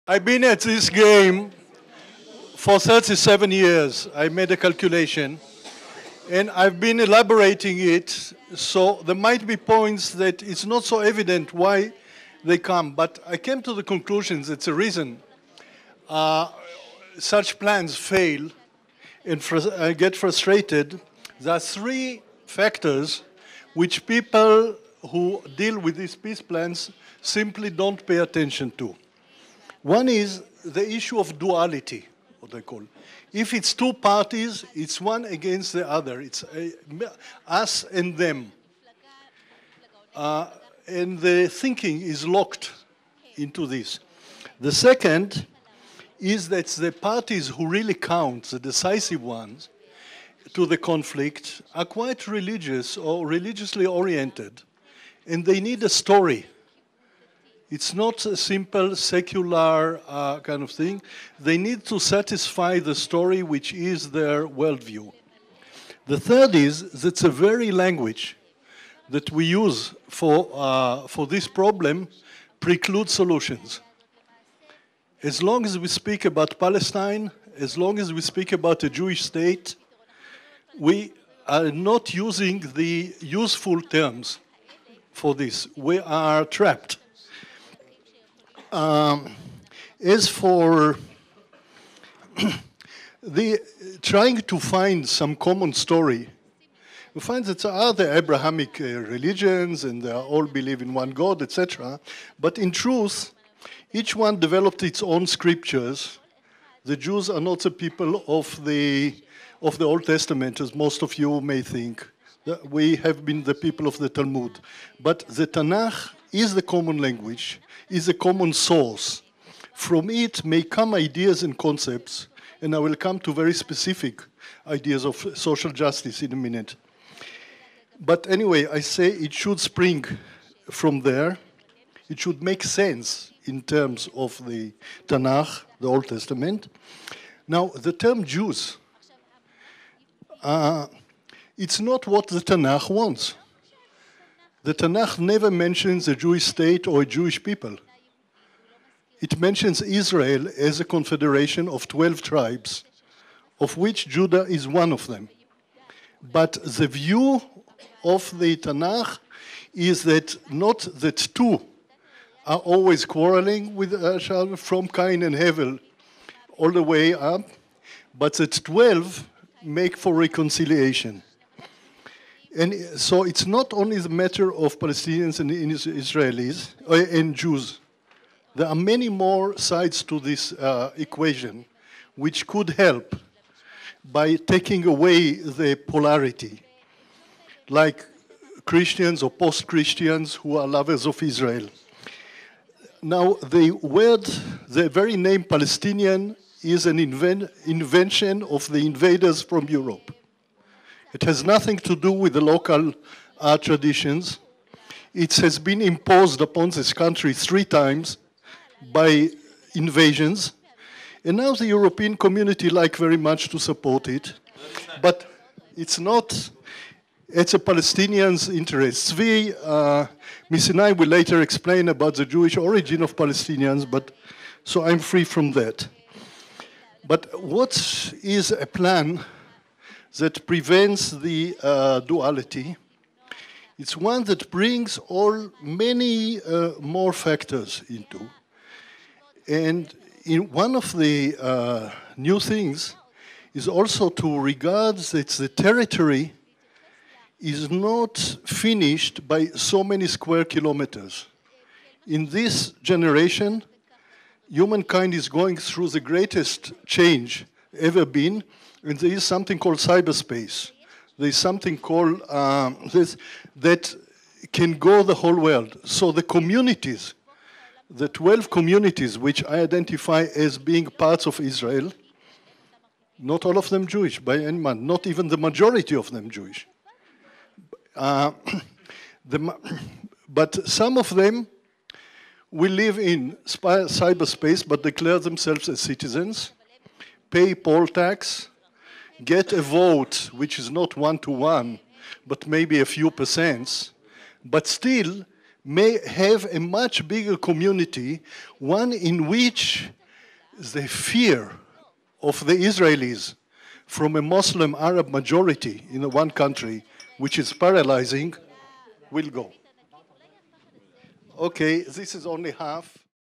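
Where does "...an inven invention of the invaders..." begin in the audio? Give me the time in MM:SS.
03:16.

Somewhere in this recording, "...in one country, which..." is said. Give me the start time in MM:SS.
05:05.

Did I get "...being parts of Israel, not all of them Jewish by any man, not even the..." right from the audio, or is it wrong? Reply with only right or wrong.
right.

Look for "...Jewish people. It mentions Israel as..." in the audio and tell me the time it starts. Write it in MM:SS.
02:27.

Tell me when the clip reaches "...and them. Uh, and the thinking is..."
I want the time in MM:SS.
00:37.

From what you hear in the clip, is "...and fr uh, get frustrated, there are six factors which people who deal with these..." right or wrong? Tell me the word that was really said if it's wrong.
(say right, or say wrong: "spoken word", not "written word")
wrong: "three", not "six".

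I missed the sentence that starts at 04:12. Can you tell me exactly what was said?
In this generation, humankind is going through the greatest change ever been.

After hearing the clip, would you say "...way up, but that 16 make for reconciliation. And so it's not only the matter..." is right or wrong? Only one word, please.
wrong.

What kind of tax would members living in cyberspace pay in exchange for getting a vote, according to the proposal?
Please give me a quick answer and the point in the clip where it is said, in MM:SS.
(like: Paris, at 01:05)
poll tax, at 04:47.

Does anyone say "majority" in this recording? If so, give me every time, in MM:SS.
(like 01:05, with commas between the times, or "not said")
04:35, 05:05.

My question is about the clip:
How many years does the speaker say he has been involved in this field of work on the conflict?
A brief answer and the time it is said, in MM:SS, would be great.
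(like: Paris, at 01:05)
37, at 00:02.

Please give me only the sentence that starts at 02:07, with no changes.
But anyway, I say it should spring from there.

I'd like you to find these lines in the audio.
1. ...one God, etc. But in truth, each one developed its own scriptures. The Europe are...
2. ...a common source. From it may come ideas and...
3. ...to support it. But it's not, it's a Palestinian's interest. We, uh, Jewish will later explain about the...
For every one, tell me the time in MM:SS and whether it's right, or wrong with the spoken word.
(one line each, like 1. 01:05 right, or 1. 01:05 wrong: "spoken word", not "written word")
1. 01:40 wrong: "Jews", not "Europe"
2. 01:58 right
3. 03:33 wrong: "Miss", not "Jewish".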